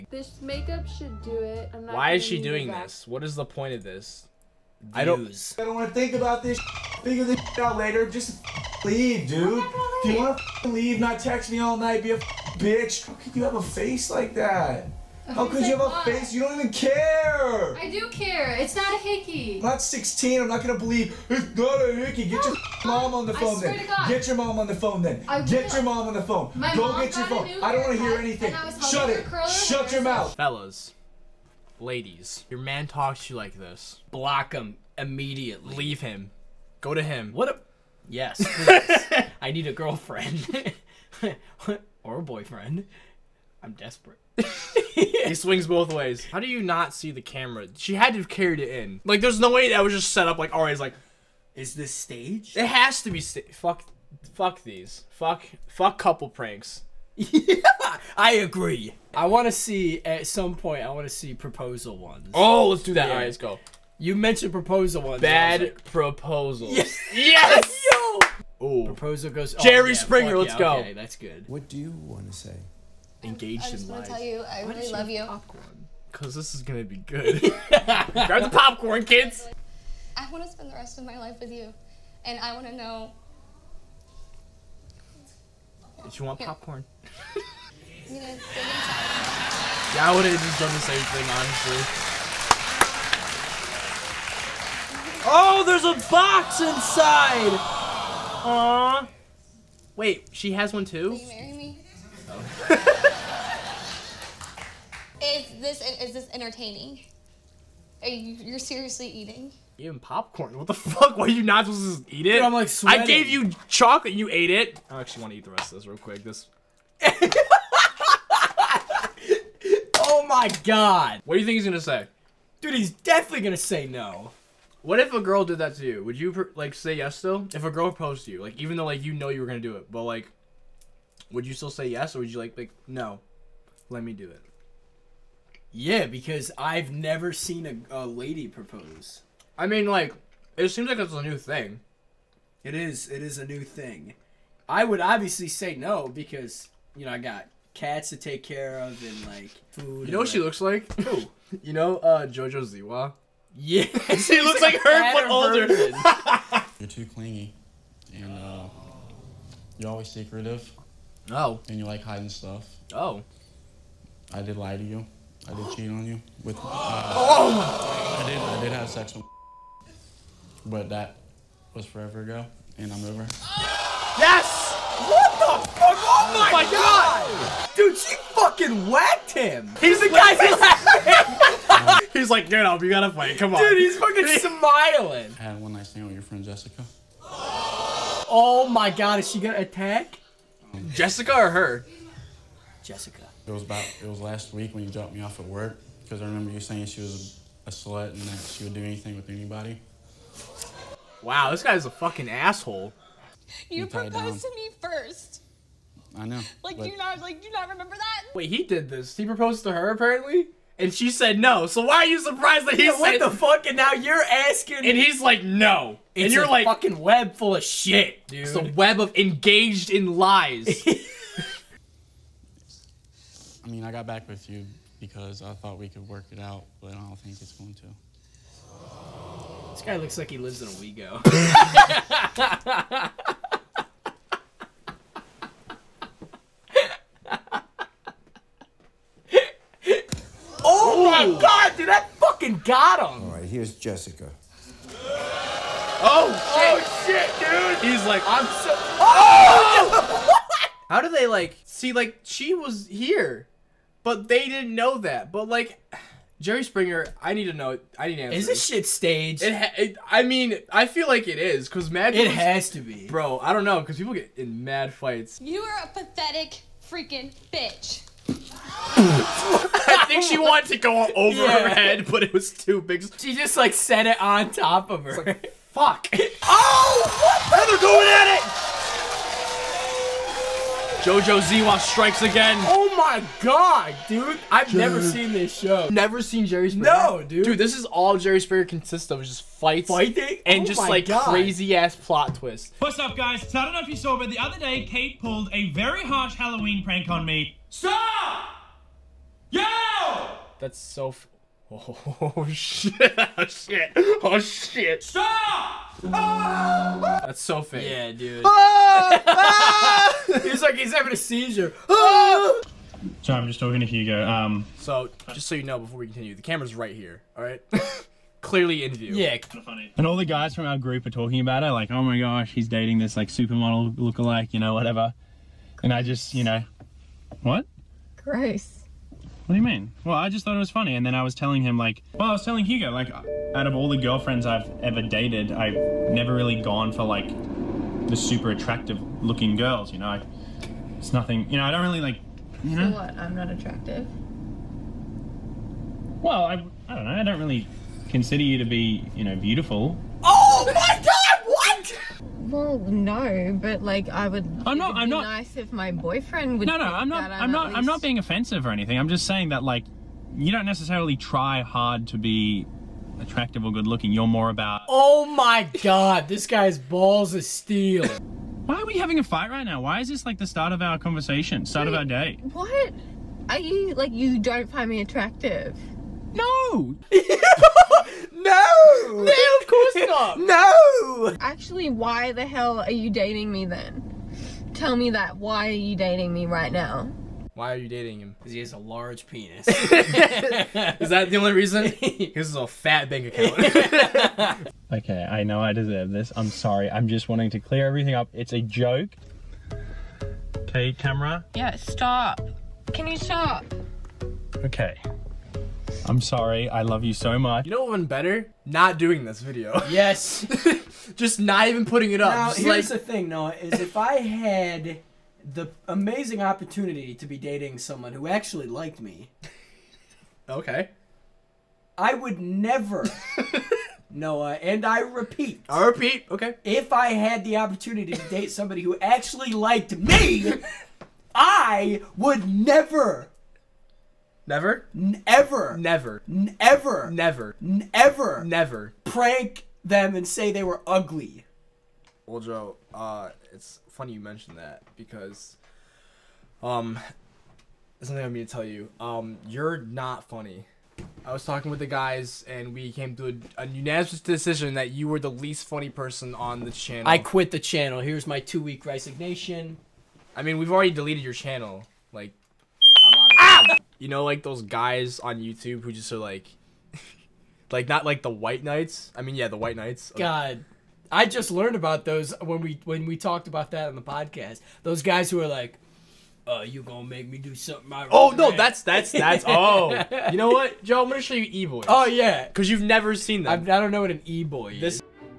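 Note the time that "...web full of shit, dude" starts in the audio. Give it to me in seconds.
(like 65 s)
216 s.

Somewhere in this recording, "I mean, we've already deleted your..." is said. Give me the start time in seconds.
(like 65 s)
460 s.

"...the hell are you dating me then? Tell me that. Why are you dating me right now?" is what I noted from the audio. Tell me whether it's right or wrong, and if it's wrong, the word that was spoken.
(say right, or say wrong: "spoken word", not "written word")
right.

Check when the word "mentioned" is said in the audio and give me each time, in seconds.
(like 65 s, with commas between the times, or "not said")
64 s, 444 s.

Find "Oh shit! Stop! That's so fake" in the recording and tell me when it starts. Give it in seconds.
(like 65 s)
304 s.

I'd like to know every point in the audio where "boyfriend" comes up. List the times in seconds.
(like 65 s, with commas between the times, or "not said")
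42 s, 355 s.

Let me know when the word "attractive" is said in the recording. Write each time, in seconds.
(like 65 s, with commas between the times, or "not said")
338 s, 343 s, 363 s, 374 s.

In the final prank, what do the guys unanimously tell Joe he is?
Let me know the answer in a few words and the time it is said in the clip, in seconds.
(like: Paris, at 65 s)
least funny person, at 455 s.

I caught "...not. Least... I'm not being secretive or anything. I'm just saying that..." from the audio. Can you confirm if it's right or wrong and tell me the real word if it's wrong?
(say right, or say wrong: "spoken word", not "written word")
wrong: "offensive", not "secretive".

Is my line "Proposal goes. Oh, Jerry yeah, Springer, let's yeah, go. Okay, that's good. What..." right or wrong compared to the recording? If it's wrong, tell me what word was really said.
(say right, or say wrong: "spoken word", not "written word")
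right.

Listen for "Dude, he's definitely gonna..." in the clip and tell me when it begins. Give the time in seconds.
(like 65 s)
122 s.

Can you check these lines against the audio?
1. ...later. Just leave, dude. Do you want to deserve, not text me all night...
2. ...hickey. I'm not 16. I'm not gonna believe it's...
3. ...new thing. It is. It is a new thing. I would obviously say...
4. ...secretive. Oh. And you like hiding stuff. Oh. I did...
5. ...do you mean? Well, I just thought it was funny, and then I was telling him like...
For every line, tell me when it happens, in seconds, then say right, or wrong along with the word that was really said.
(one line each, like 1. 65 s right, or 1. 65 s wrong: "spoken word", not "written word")
1. 7 s wrong: "leave", not "deserve"
2. 18 s right
3. 141 s right
4. 160 s right
5. 329 s right.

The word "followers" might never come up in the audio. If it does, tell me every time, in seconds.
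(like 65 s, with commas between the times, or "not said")
not said.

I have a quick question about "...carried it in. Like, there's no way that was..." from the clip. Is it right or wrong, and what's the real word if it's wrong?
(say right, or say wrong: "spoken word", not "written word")
right.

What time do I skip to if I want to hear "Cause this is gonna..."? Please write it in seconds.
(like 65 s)
76 s.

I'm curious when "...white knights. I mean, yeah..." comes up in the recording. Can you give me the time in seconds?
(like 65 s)
468 s.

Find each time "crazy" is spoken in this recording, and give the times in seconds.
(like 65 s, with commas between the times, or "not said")
291 s.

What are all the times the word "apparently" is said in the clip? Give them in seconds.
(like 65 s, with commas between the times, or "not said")
209 s.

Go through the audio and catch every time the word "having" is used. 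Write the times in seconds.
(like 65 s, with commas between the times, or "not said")
310 s, 368 s.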